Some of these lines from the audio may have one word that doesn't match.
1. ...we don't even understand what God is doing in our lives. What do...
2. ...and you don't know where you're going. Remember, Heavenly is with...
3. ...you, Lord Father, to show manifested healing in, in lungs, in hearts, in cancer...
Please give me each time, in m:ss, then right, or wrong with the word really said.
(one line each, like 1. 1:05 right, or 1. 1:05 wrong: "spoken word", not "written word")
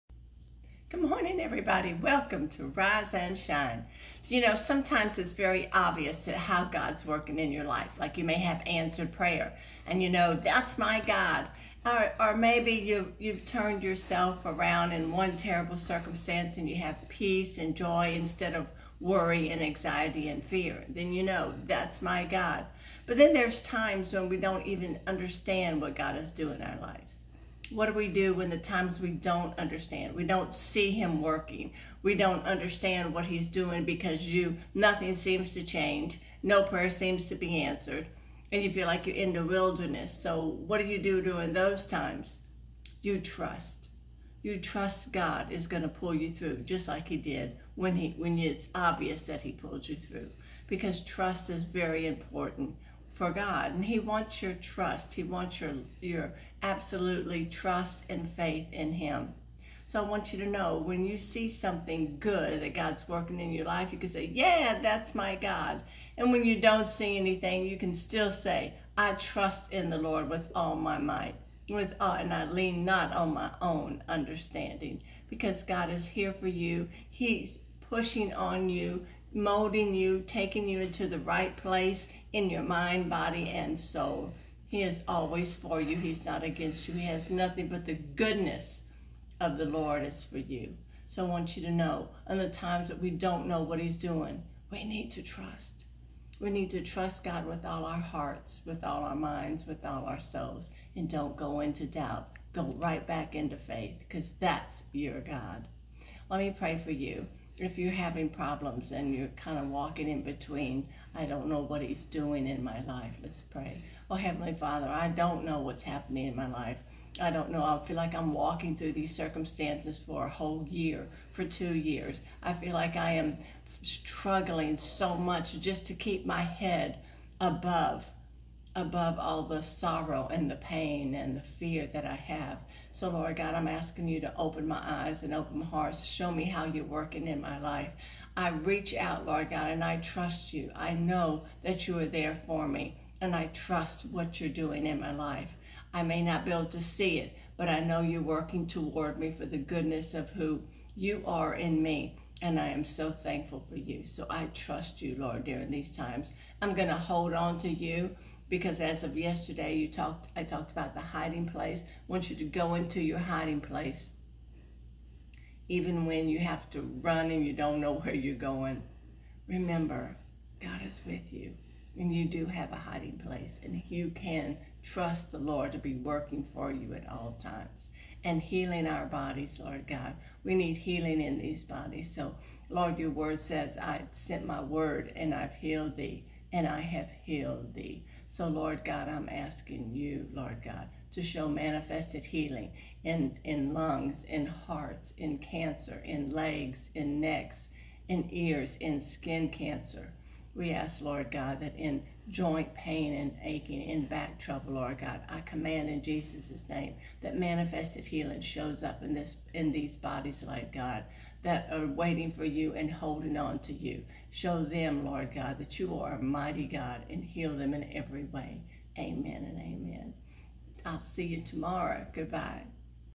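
1. 0:24 right
2. 2:47 wrong: "God", not "Heavenly"
3. 3:09 wrong: "God", not "Father".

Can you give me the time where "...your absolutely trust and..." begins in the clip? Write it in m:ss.
0:56.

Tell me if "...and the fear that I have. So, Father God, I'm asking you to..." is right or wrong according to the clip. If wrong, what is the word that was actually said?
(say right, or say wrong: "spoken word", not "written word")
wrong: "Lord", not "Father".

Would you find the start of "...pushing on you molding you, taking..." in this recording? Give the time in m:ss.
1:17.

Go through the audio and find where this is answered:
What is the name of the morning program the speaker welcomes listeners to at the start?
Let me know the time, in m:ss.
0:02.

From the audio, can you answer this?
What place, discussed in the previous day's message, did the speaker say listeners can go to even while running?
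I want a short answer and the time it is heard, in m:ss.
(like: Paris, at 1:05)
the hiding place, at 2:40.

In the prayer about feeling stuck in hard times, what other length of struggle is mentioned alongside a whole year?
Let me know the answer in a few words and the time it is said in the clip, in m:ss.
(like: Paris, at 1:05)
2 years, at 2:01.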